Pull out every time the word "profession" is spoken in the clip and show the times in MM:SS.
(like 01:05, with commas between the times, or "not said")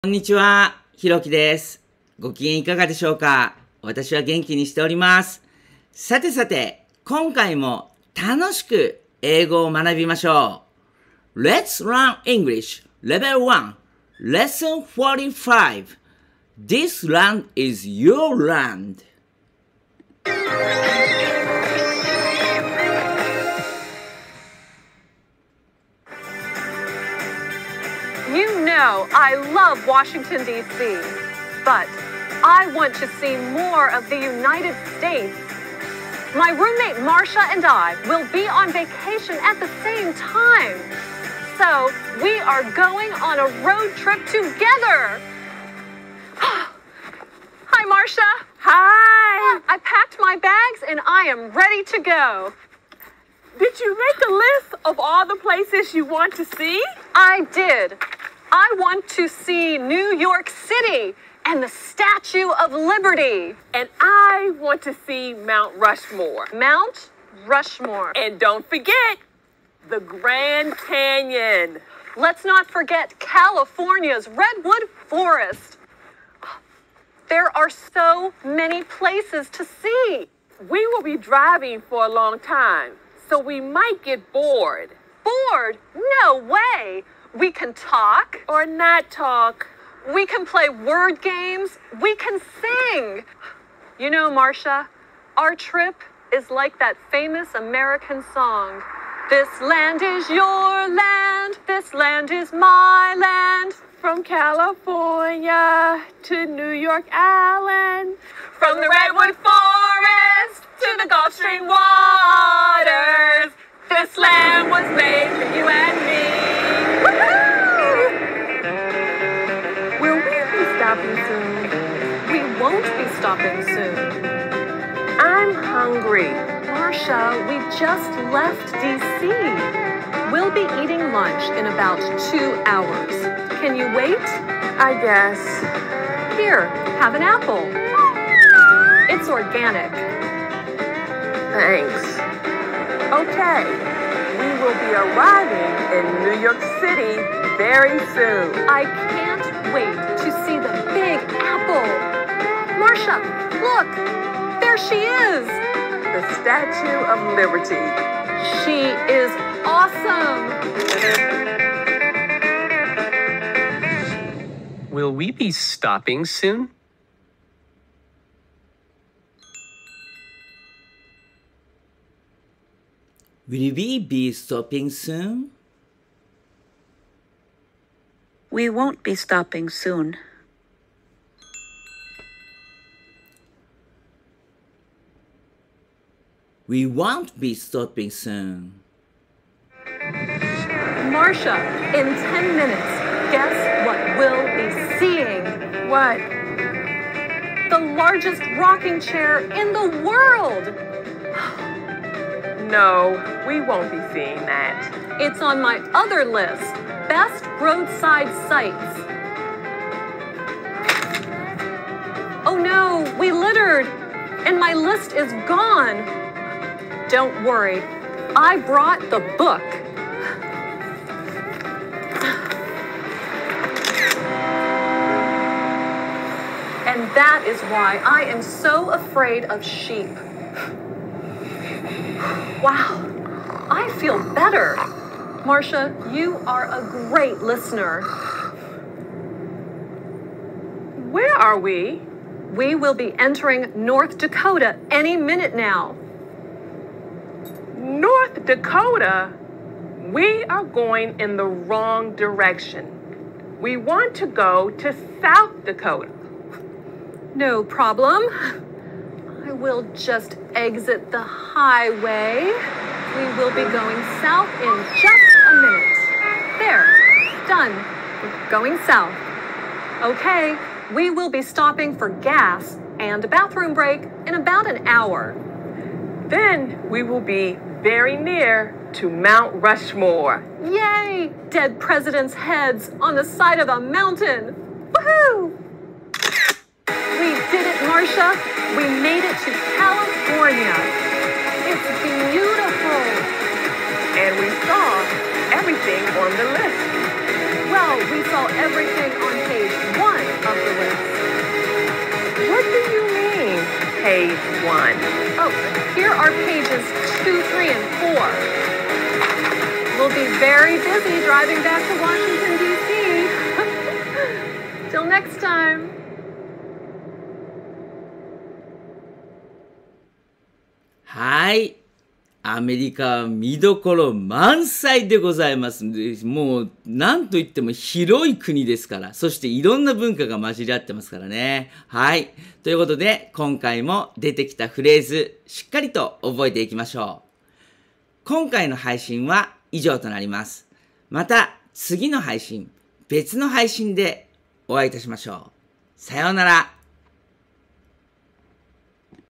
not said.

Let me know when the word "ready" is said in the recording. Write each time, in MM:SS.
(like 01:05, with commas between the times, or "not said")
00:51.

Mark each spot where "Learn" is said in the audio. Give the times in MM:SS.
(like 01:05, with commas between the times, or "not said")
00:11.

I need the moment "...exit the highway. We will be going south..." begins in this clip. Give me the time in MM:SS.
04:20.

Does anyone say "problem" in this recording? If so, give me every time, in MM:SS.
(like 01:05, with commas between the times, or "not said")
04:17.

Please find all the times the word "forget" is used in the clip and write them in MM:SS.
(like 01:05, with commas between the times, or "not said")
01:08, 01:12.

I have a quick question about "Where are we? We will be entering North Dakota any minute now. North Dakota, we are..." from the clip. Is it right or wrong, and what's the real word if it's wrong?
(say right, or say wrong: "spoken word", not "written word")
right.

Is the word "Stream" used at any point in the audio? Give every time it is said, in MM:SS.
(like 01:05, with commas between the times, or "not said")
01:51.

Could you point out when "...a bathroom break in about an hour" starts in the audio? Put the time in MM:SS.
04:33.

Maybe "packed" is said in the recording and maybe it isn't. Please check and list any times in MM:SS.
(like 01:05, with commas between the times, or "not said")
00:49.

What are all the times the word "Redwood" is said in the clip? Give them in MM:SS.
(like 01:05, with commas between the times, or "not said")
01:14, 01:48.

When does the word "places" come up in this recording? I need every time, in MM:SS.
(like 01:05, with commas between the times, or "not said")
00:55, 01:18.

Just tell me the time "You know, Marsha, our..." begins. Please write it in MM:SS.
01:33.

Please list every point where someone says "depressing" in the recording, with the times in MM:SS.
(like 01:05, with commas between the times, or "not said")
not said.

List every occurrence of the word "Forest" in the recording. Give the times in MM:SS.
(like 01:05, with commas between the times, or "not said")
01:15, 01:49.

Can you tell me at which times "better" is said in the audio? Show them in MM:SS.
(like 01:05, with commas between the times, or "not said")
03:54.